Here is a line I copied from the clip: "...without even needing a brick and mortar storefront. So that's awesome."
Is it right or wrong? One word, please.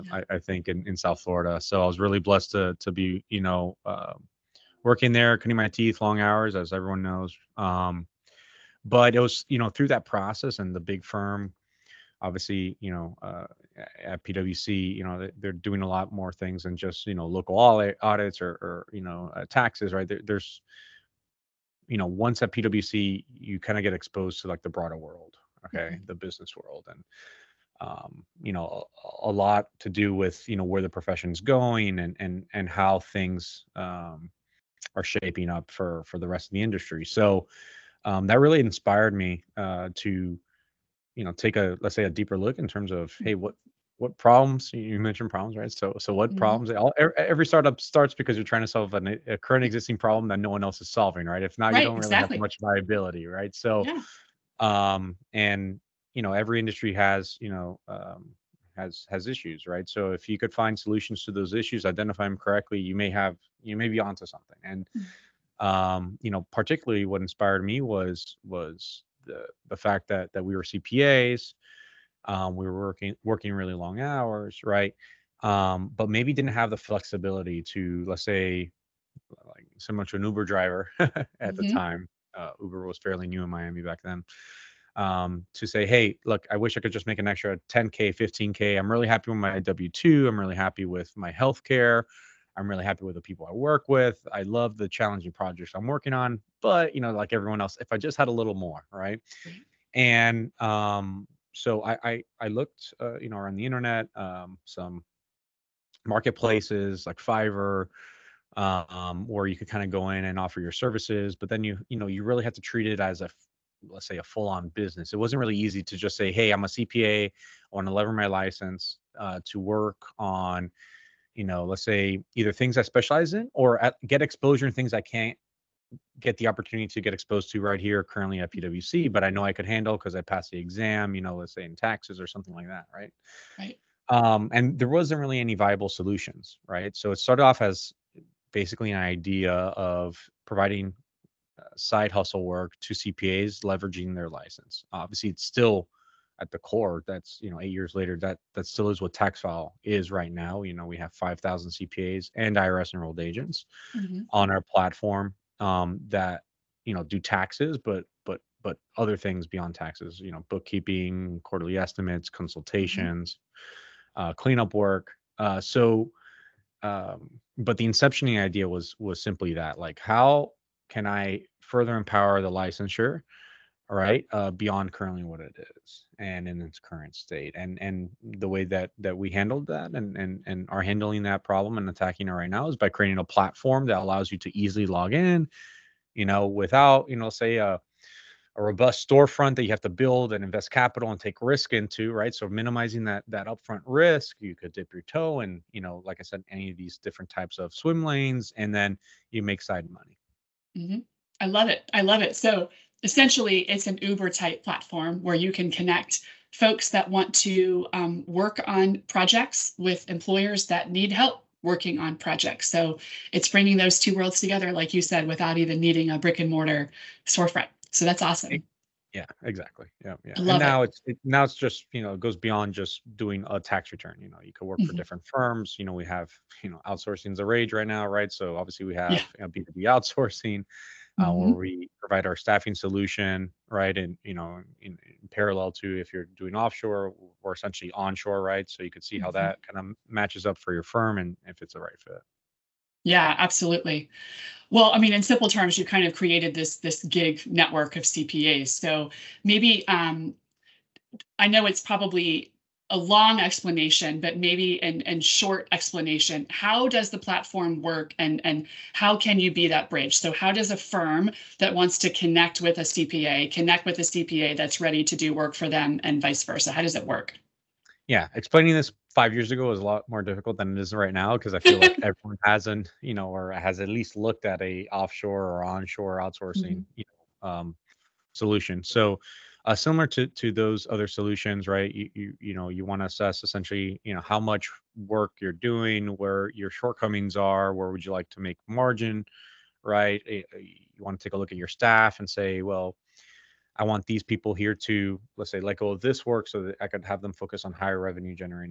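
right.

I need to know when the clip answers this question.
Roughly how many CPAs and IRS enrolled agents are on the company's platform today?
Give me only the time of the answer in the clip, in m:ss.
2:31.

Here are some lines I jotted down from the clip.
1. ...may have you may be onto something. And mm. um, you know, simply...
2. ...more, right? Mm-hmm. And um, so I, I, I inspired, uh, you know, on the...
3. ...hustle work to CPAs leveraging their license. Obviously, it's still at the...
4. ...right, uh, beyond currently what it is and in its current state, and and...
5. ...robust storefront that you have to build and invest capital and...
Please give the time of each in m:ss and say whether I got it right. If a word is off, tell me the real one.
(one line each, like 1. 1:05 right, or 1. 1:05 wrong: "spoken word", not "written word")
1. 1:02 wrong: "particularly", not "simply"
2. 1:38 wrong: "looked", not "inspired"
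3. 2:22 right
4. 2:53 right
5. 3:08 right.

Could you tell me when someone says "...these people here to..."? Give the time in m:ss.
4:54.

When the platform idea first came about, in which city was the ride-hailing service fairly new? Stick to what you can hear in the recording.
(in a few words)
Miami.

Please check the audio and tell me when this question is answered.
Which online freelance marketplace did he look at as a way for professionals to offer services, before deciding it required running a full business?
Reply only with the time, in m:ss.
1:47.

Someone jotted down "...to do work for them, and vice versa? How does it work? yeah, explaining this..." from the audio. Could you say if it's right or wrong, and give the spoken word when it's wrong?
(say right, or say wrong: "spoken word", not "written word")
right.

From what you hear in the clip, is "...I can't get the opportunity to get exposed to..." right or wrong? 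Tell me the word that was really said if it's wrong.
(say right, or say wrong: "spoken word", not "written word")
right.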